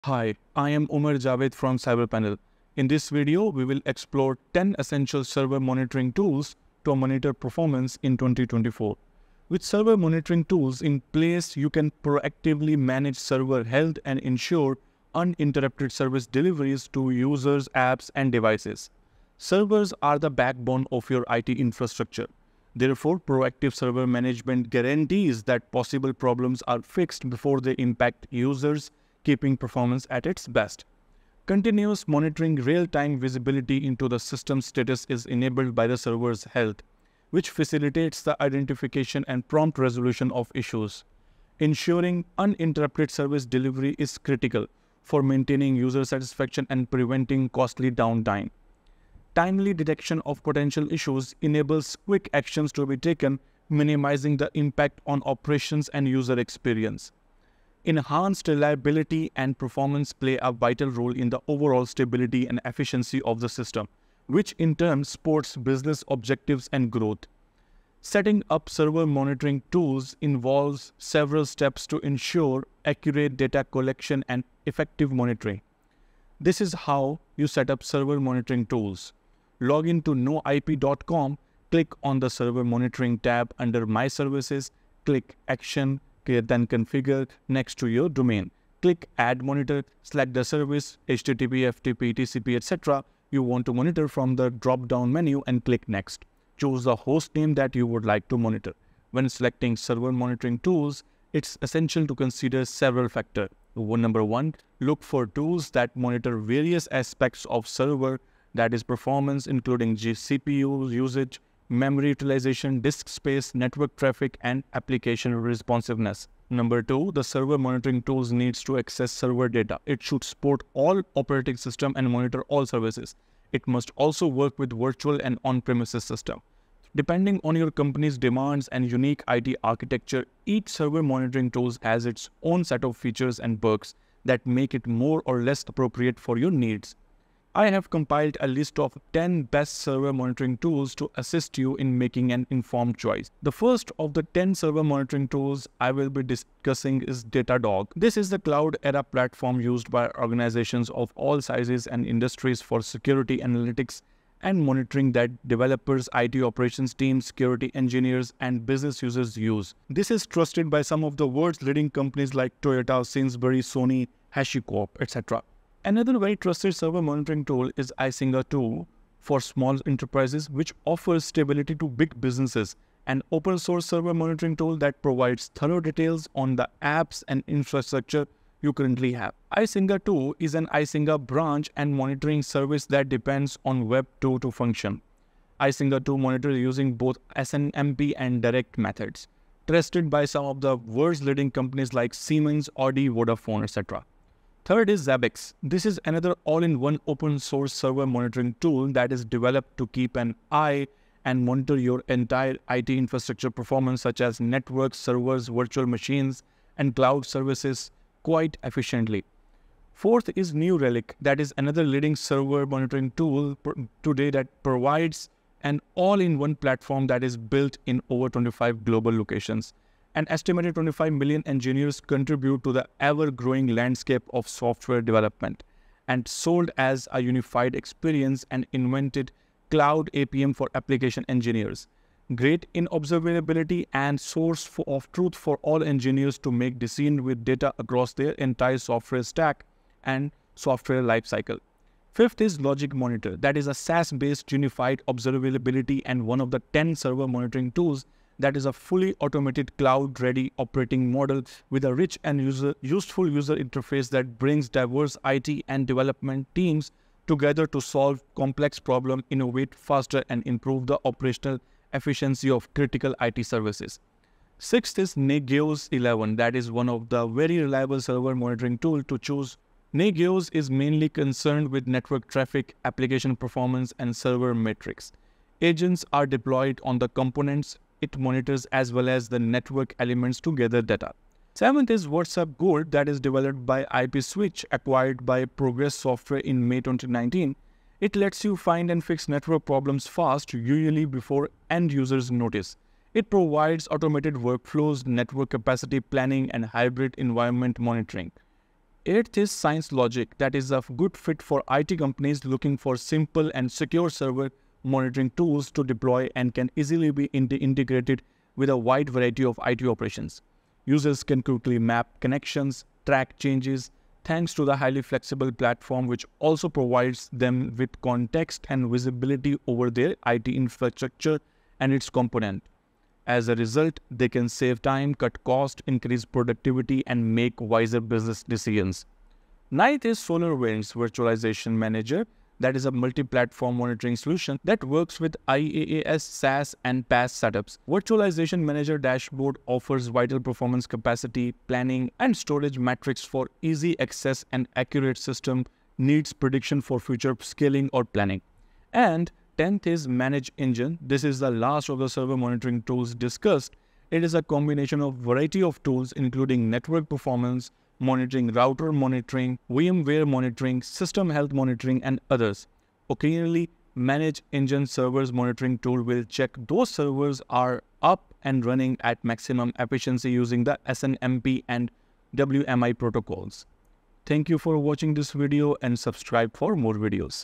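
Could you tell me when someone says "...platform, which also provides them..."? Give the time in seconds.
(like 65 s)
315 s.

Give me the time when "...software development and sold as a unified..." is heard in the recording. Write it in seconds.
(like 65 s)
224 s.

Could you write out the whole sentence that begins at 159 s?
This is trusted by some of the world's leading companies like Toyota, Sainsbury, Sony, HashiCorp, etc.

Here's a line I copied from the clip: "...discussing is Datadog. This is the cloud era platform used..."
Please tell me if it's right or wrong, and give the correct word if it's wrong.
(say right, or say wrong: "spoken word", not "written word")
right.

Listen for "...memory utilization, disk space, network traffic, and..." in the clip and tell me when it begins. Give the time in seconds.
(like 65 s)
111 s.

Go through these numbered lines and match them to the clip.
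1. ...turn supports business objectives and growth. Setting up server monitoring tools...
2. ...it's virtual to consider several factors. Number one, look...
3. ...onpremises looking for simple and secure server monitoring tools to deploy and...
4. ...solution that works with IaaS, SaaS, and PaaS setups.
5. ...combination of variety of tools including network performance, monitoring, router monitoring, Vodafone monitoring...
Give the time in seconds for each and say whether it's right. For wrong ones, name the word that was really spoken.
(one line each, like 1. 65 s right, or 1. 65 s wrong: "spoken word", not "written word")
1. 64 s right
2. 101 s wrong: "essential", not "virtual"
3. 301 s wrong: "companies", not "onpremises"
4. 334 s right
5. 354 s wrong: "VMware", not "Vodafone".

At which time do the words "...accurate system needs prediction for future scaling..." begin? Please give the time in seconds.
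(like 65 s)
344 s.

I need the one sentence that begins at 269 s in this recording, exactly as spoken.
Nagios is mainly concerned with network traffic, application performance, and server metrics.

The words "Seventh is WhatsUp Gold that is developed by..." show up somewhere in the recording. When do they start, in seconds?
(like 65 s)
281 s.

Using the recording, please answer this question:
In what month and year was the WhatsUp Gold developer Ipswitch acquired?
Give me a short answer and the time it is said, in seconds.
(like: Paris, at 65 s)
May 2019, at 286 s.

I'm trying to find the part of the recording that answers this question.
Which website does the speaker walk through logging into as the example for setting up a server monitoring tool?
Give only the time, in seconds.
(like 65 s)
80 s.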